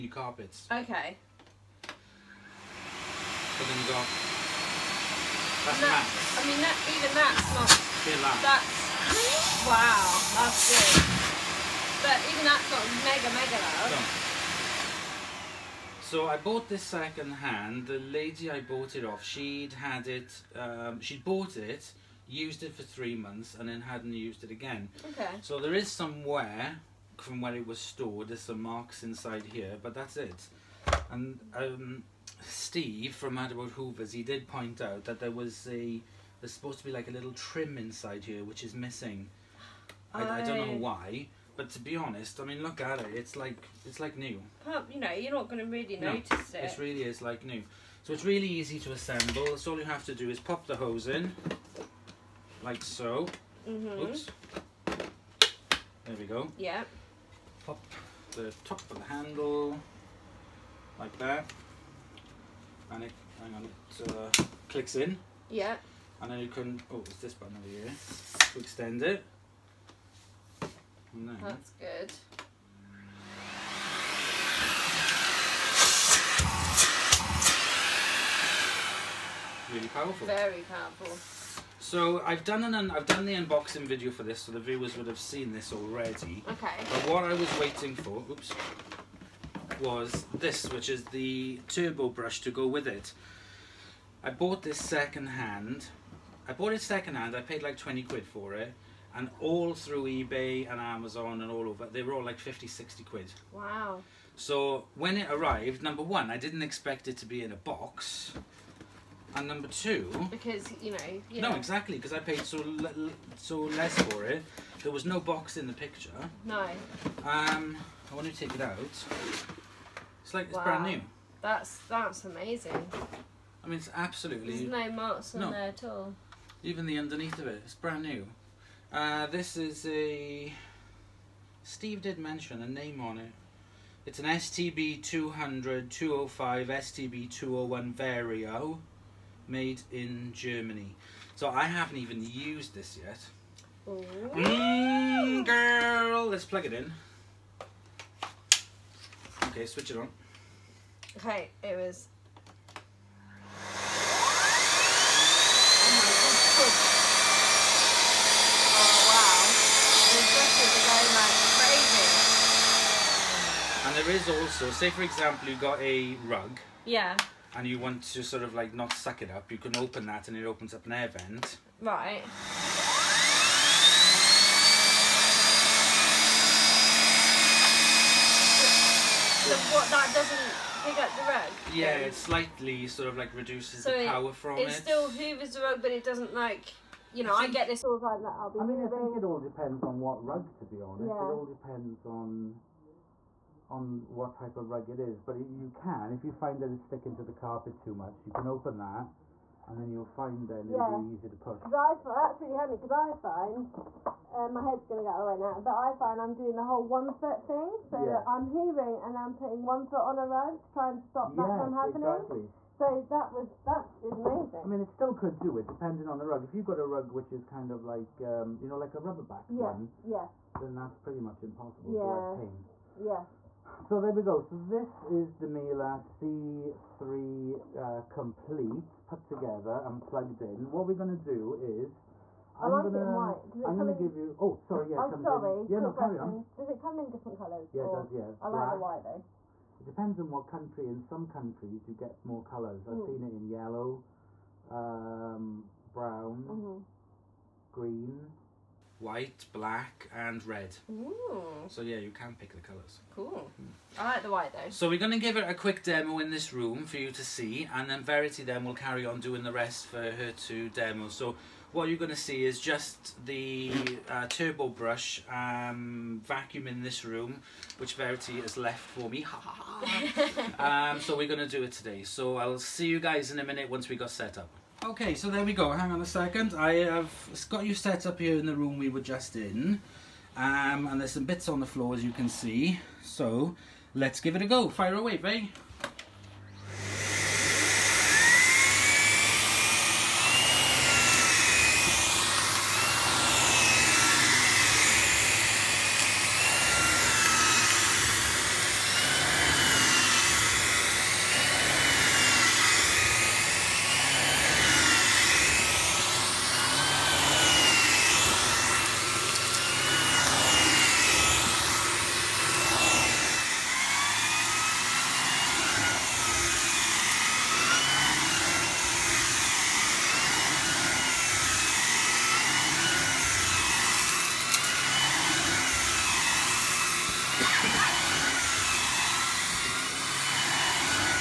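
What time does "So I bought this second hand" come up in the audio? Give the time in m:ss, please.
0:16.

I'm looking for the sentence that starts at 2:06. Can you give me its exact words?
Even the underneath of it, it's brand new.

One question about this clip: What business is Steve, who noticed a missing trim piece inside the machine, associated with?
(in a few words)
Mad About Hoovers.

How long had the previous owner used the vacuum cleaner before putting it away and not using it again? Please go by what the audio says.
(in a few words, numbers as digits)
3 months.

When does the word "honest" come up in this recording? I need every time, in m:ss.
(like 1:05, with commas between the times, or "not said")
0:41, 3:10.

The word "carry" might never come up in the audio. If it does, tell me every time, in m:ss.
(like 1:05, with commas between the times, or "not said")
3:56, 4:18.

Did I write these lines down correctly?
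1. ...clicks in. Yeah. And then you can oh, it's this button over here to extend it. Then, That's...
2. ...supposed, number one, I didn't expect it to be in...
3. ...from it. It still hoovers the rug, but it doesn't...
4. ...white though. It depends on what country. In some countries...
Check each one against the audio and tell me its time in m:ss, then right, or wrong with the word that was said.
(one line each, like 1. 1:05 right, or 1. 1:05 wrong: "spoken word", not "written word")
1. 1:04 right
2. 1:45 wrong: "arrived", not "supposed"
3. 3:04 right
4. 3:58 right.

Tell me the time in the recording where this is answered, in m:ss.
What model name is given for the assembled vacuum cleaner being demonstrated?
3:45.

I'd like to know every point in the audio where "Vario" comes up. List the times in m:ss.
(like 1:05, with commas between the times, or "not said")
2:17.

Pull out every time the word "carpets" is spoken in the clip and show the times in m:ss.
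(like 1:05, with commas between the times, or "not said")
0:00, 3:17.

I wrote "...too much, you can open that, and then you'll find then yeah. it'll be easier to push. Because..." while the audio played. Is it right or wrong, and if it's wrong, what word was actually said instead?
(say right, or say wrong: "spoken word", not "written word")
right.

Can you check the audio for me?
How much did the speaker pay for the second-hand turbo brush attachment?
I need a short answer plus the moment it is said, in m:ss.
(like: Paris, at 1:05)
£20, at 1:37.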